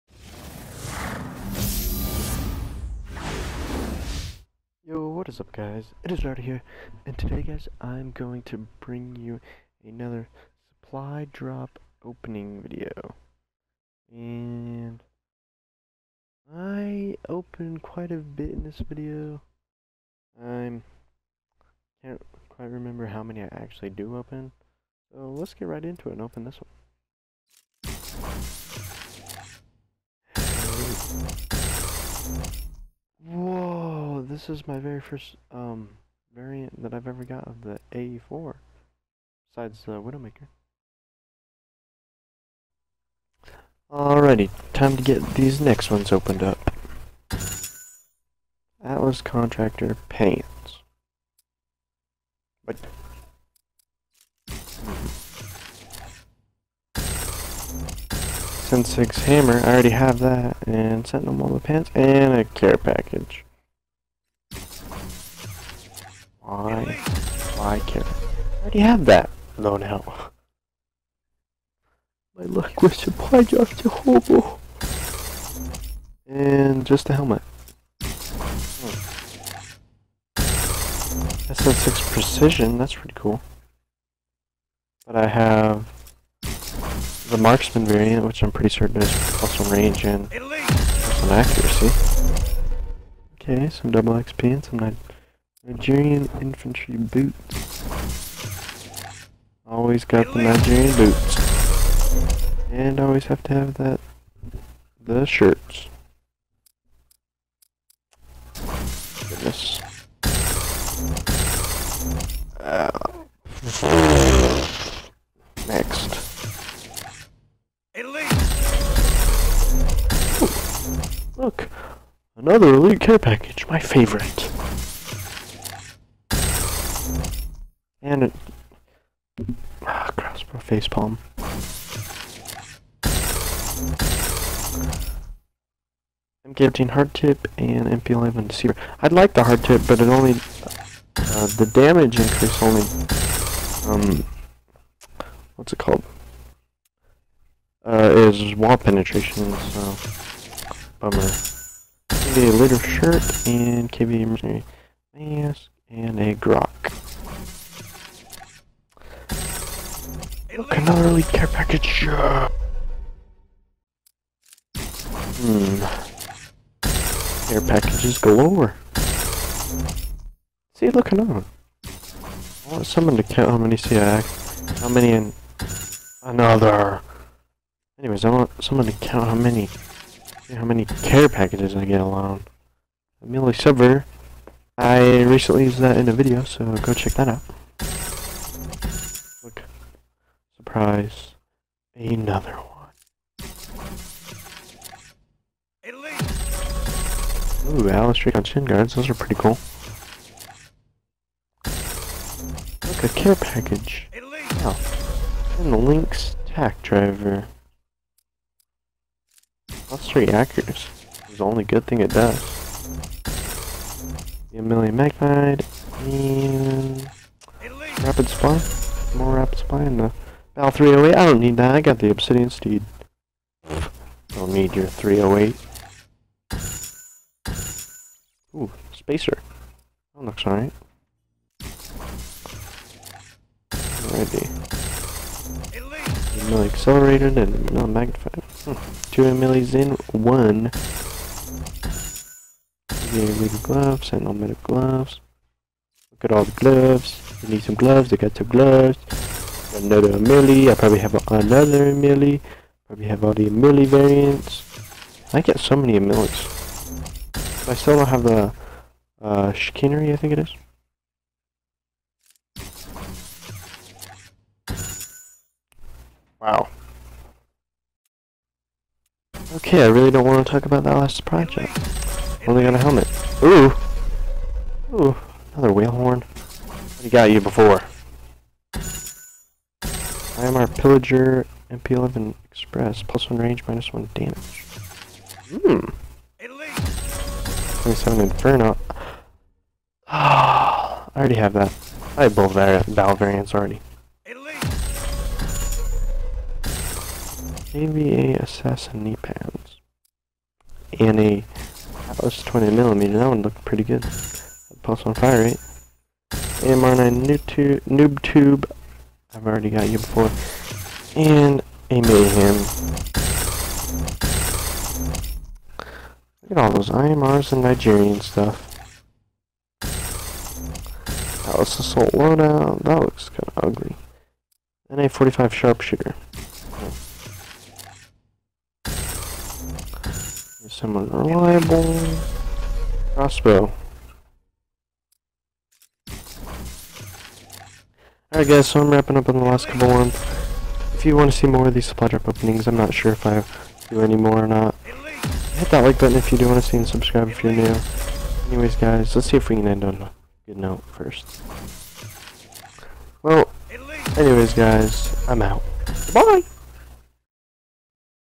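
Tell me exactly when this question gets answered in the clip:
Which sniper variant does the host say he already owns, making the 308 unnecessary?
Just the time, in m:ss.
3:42.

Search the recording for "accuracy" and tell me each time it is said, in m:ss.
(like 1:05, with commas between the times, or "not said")
1:31, 3:30.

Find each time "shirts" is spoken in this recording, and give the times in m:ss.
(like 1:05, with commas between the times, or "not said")
1:45, 2:32.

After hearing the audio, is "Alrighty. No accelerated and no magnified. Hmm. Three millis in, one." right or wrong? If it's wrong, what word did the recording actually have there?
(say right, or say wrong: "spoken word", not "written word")
wrong: "Two", not "Three".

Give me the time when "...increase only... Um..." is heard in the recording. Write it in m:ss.
2:22.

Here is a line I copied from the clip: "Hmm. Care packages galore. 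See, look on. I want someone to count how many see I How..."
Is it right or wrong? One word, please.
right.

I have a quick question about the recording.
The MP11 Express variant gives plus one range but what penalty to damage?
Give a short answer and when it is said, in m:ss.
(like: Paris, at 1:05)
minus 1 damage, at 4:43.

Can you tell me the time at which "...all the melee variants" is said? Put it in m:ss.
4:13.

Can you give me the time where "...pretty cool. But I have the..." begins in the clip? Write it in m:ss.
1:22.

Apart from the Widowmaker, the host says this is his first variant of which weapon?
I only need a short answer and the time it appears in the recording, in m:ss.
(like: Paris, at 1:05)
A4, at 0:37.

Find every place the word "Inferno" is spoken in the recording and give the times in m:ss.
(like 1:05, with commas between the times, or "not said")
4:48.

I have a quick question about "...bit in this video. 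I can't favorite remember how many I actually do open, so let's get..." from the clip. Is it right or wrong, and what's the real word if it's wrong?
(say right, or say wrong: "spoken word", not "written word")
wrong: "quite", not "favorite".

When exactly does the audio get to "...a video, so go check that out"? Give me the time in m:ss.
3:06.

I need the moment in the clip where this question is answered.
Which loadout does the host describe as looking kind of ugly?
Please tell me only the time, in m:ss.
5:21.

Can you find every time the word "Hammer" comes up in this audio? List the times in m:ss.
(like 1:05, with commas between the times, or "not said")
0:59.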